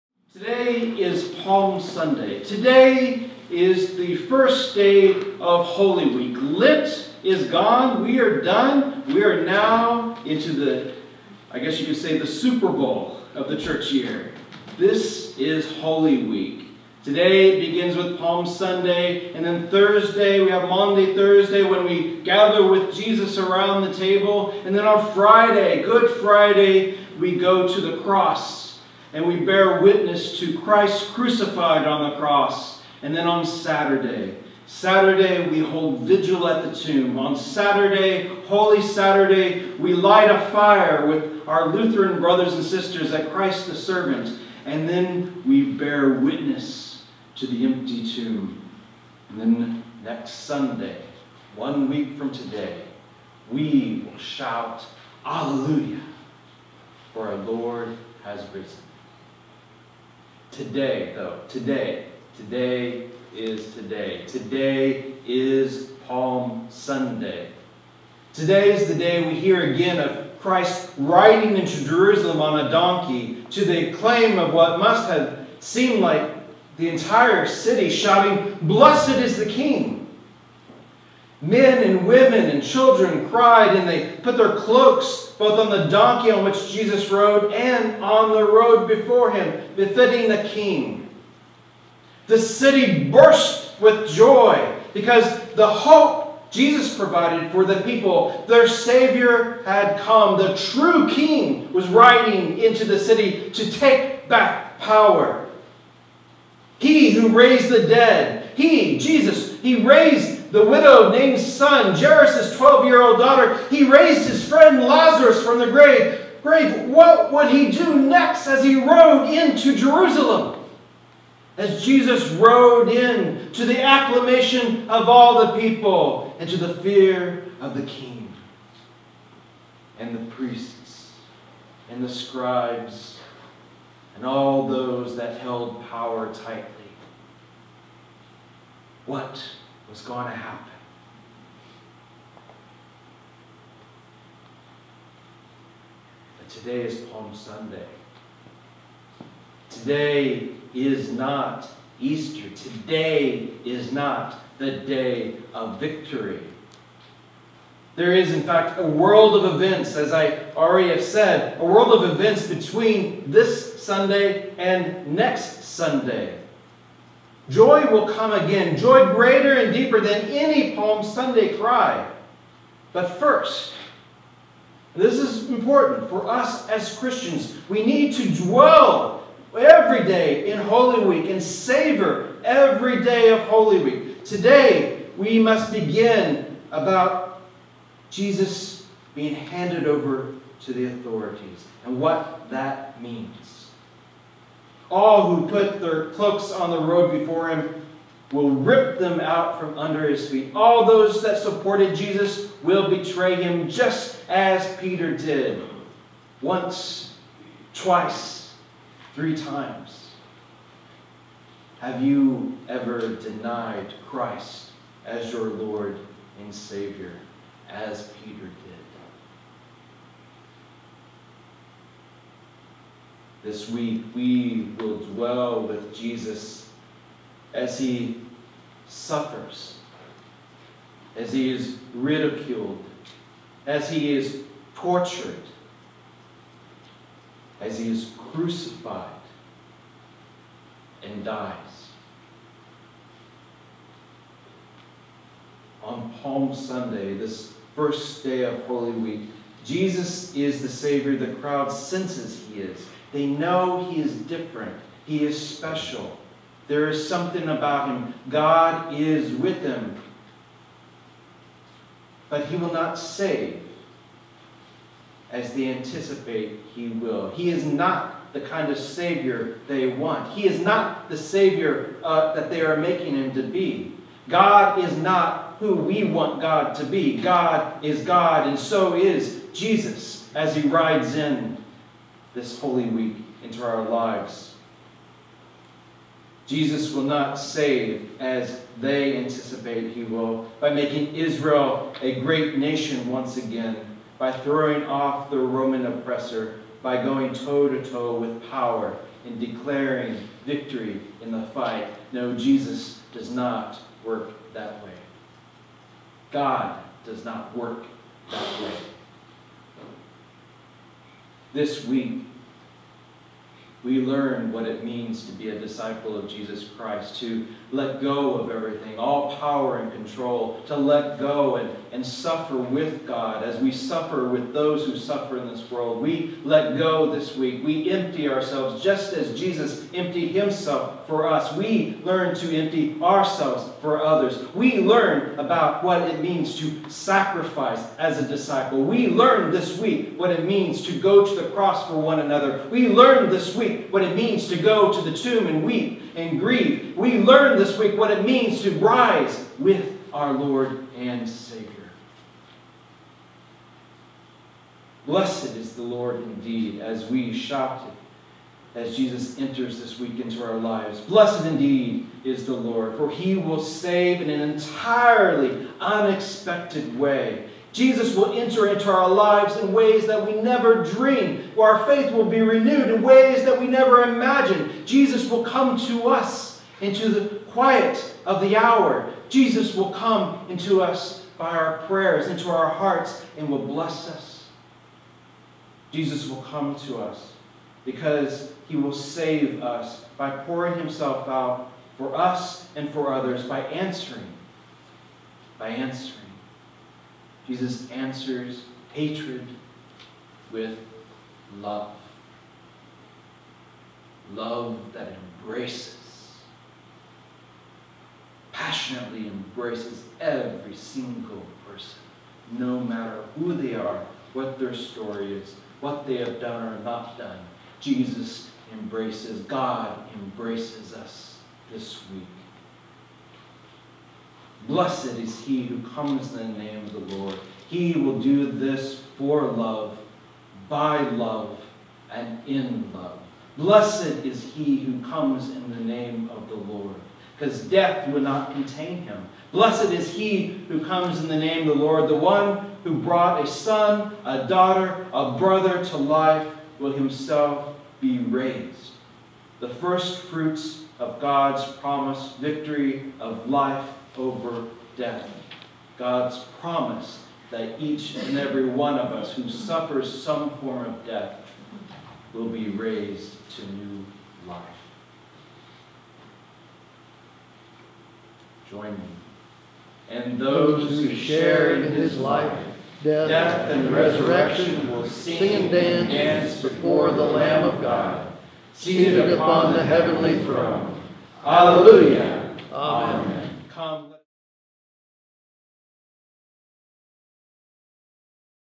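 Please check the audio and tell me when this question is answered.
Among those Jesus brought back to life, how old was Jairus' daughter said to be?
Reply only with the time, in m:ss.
1:52.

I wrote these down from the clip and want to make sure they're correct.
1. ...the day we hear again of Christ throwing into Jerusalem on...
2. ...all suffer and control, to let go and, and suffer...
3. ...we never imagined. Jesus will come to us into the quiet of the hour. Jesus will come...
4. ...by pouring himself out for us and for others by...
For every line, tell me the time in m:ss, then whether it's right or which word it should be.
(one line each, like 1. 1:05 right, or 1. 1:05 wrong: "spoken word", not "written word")
1. 1:08 wrong: "riding", not "throwing"
2. 5:18 wrong: "power", not "suffer"
3. 6:13 right
4. 6:30 right.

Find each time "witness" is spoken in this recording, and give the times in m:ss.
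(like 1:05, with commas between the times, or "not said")
0:29, 0:46.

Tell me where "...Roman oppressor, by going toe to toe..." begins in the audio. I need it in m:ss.
4:55.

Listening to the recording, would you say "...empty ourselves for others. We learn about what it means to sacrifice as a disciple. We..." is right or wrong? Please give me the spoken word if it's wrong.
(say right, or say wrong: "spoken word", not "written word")
right.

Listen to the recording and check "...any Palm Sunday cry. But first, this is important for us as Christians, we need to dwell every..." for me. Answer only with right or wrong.
right.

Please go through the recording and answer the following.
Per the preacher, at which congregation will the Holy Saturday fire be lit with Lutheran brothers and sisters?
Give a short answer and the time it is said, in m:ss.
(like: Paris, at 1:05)
Christ the Servant, at 0:43.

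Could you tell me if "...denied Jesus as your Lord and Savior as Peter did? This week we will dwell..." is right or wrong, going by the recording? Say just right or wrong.
wrong.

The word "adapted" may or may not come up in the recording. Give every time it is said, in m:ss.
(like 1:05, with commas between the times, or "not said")
not said.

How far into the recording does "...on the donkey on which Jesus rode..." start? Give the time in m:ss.
1:25.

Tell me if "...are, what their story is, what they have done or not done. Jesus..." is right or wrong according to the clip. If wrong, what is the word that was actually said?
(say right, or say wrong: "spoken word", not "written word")
right.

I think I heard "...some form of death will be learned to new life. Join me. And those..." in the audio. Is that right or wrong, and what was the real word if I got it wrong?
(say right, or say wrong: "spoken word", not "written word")
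wrong: "raised", not "learned".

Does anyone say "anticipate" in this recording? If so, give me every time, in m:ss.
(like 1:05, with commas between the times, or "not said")
4:25, 4:49.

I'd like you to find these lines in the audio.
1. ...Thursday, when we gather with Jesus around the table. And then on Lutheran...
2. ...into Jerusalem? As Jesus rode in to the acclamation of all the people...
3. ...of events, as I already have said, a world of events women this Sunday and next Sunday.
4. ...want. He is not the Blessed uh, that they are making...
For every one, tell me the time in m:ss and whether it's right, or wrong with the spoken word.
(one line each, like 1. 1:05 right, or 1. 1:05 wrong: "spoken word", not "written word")
1. 0:21 wrong: "Friday", not "Lutheran"
2. 1:59 right
3. 2:39 wrong: "between", not "women"
4. 4:29 wrong: "Savior", not "Blessed".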